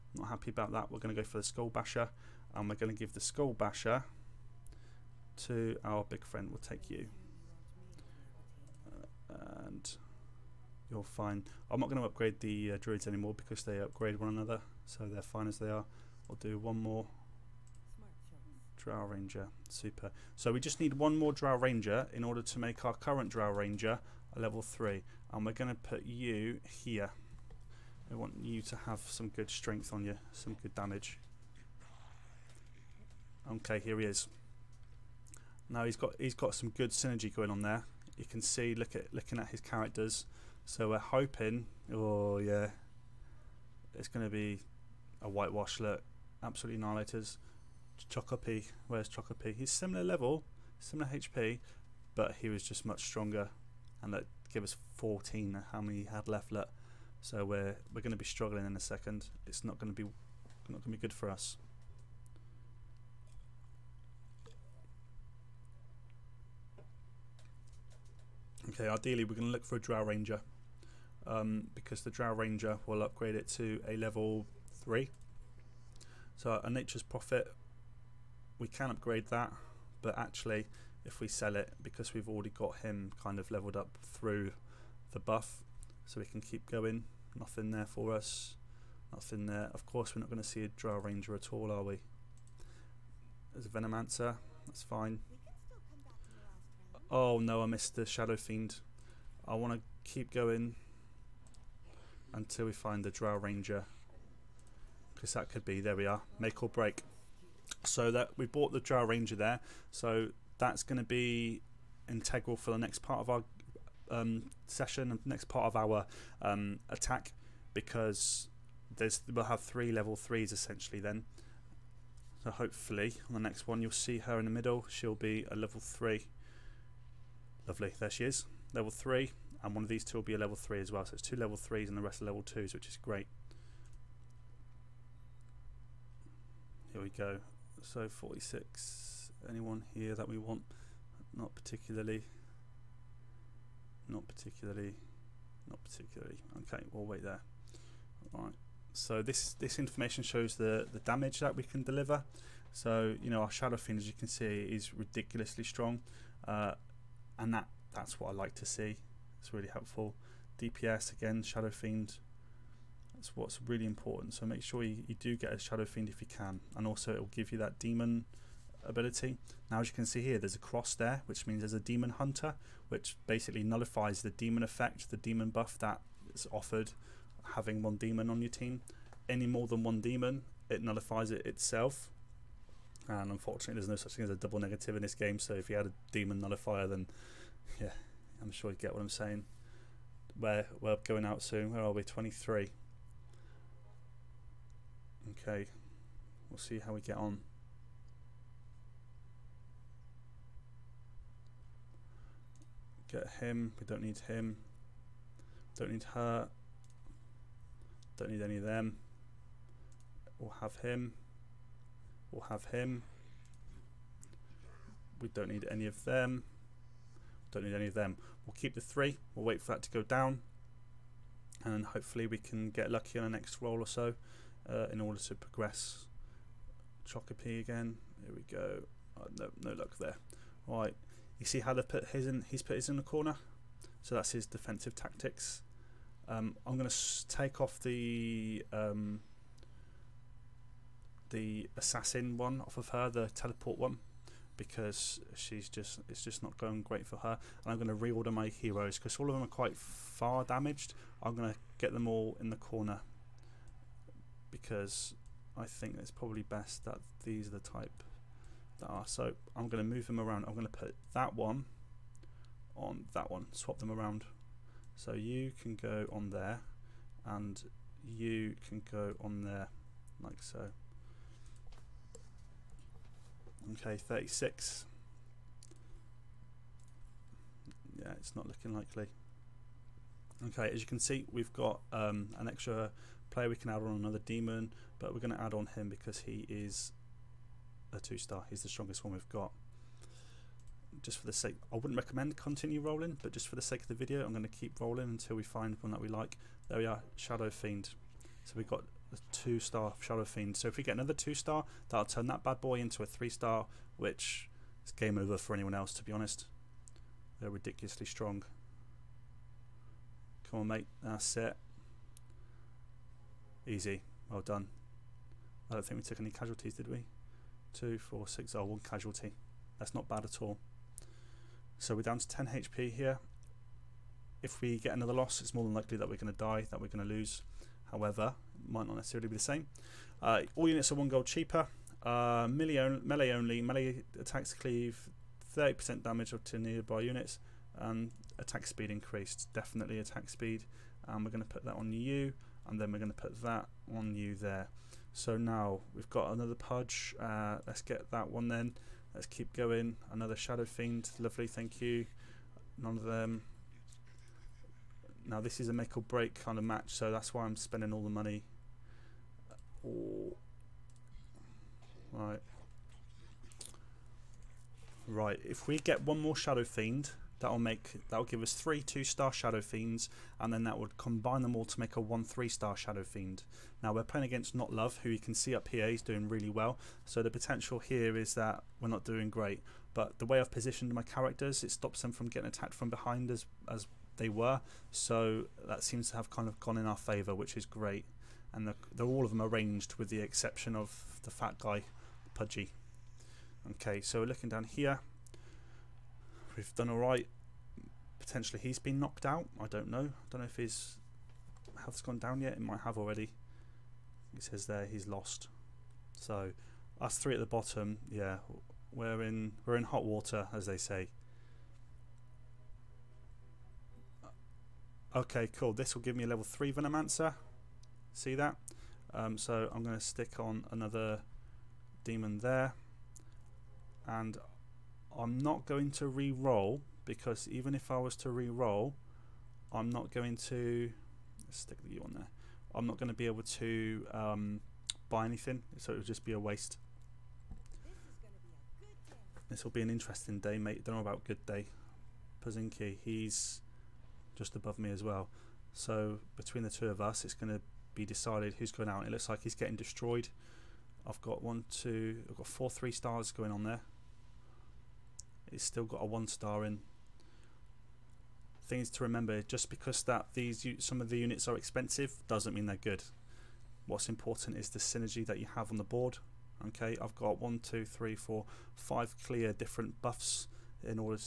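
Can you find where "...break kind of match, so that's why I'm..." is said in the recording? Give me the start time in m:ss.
5:56.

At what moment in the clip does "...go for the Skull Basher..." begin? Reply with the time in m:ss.
0:01.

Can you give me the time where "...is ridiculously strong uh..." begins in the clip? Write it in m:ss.
2:34.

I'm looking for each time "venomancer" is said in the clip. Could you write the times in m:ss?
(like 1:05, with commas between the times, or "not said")
1:33, 6:56.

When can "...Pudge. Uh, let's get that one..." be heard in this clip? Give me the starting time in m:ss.
5:46.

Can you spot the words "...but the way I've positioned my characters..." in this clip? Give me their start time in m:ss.
6:19.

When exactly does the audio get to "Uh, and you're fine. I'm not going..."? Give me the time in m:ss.
0:09.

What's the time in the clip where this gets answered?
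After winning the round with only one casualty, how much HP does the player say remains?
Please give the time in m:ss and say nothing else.
5:22.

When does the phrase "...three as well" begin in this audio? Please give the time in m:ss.
2:10.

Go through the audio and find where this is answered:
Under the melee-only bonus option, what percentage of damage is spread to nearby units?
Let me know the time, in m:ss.
5:35.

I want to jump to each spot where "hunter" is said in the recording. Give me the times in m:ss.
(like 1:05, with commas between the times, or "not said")
2:52.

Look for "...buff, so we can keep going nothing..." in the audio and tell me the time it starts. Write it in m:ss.
1:25.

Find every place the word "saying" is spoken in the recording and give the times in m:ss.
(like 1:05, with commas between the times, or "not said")
3:09.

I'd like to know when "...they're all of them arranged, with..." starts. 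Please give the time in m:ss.
6:28.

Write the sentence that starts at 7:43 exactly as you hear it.
What's important is the synergy that you have on the board.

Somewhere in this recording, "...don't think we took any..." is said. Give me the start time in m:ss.
5:15.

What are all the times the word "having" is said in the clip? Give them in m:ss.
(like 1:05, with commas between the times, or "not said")
2:57.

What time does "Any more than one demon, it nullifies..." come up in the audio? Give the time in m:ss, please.
2:59.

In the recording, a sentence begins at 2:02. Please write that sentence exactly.
So hopefully on the next one you'll see her in the middle.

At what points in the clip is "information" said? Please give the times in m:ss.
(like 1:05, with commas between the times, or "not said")
2:29.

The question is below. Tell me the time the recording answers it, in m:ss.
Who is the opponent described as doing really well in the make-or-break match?
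6:14.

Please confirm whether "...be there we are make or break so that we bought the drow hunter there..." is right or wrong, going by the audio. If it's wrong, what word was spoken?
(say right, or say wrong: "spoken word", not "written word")
wrong: "ranger", not "hunter".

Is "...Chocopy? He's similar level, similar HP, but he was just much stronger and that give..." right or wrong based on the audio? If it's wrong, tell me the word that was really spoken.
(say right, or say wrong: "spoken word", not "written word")
right.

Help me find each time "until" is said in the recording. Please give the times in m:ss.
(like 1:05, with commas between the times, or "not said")
1:42, 4:55.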